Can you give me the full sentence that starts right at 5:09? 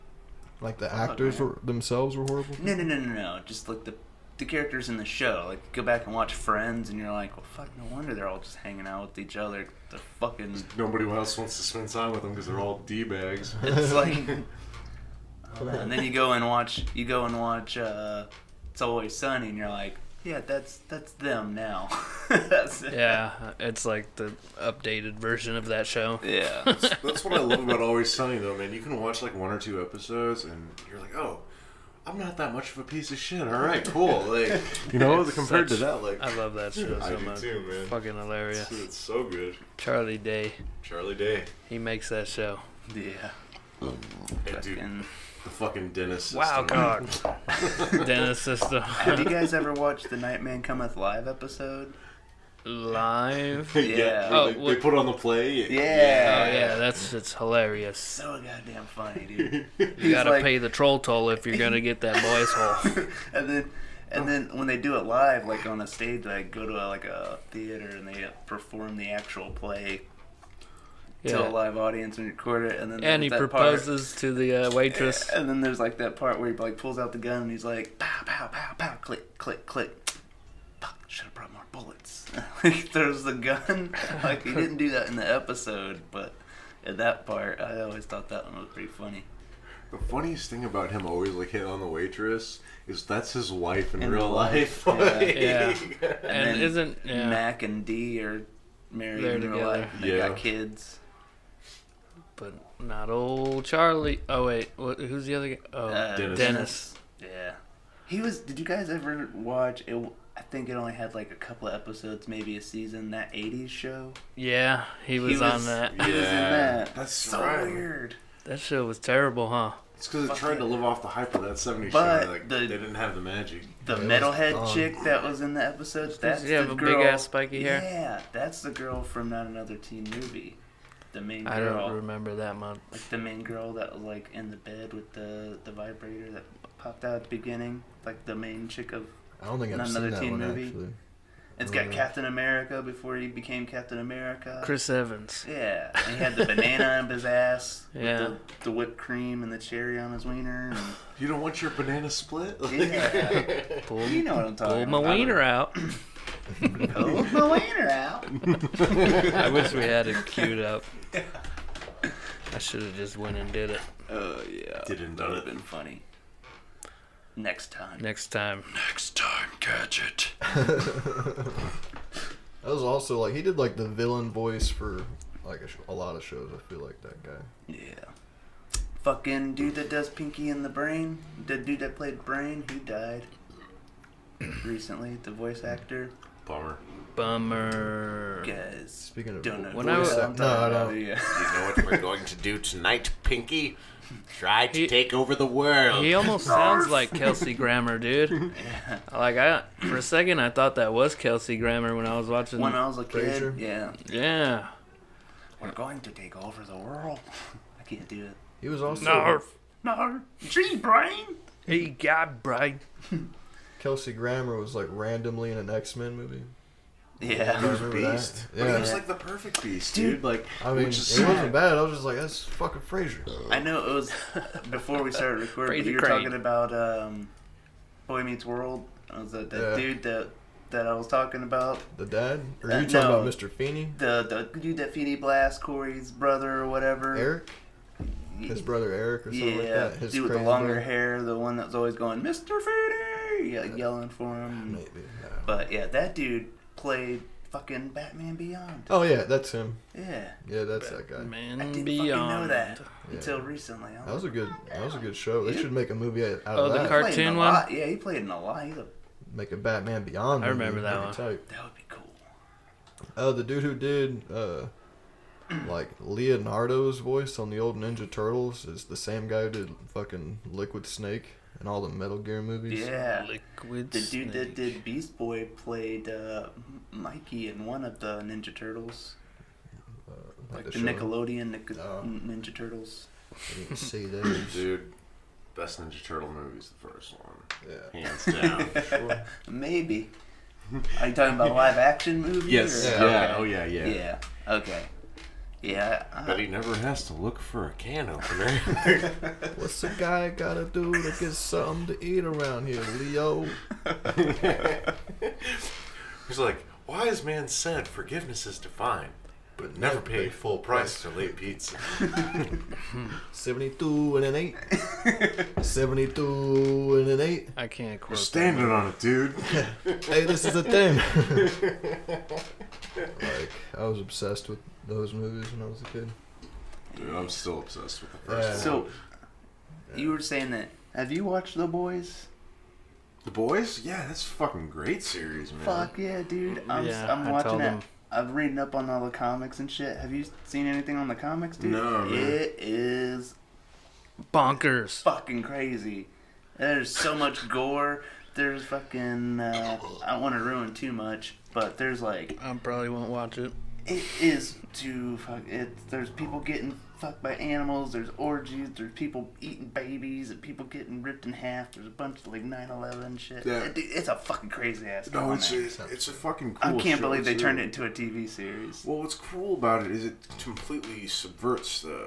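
but never pay full price for late pizza.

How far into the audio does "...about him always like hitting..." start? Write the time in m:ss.
1:30.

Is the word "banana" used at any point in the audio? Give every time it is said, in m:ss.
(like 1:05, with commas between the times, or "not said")
2:26, 2:31.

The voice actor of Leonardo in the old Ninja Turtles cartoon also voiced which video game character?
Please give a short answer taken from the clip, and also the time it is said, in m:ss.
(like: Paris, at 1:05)
Liquid Snake, at 4:30.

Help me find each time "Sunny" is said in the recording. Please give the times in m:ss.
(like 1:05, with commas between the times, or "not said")
0:19, 0:28.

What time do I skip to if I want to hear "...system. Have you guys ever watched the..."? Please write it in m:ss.
0:48.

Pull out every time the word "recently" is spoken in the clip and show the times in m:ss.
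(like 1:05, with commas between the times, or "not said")
3:04, 4:13.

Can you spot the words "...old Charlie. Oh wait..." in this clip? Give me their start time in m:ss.
1:43.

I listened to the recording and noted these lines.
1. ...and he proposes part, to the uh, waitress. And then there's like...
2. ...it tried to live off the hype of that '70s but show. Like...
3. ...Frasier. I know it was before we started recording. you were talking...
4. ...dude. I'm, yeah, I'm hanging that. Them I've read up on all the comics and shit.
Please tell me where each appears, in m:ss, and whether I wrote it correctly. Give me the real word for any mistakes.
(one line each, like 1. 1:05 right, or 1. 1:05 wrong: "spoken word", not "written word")
1. 1:13 right
2. 2:00 right
3. 3:42 right
4. 5:36 wrong: "watching", not "hanging".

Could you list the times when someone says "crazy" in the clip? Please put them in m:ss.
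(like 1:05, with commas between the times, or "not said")
5:45, 6:04.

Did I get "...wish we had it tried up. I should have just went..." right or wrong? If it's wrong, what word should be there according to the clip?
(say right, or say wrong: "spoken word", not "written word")
wrong: "queued", not "tried".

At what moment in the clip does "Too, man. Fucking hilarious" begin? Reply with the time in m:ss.
0:37.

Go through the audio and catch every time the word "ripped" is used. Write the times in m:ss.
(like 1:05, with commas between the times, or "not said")
6:01.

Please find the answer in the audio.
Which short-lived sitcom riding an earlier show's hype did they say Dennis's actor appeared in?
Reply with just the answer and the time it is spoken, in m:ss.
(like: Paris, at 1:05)
That '80s Show, at 1:53.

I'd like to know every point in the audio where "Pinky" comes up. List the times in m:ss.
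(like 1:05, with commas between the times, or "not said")
3:00, 3:13.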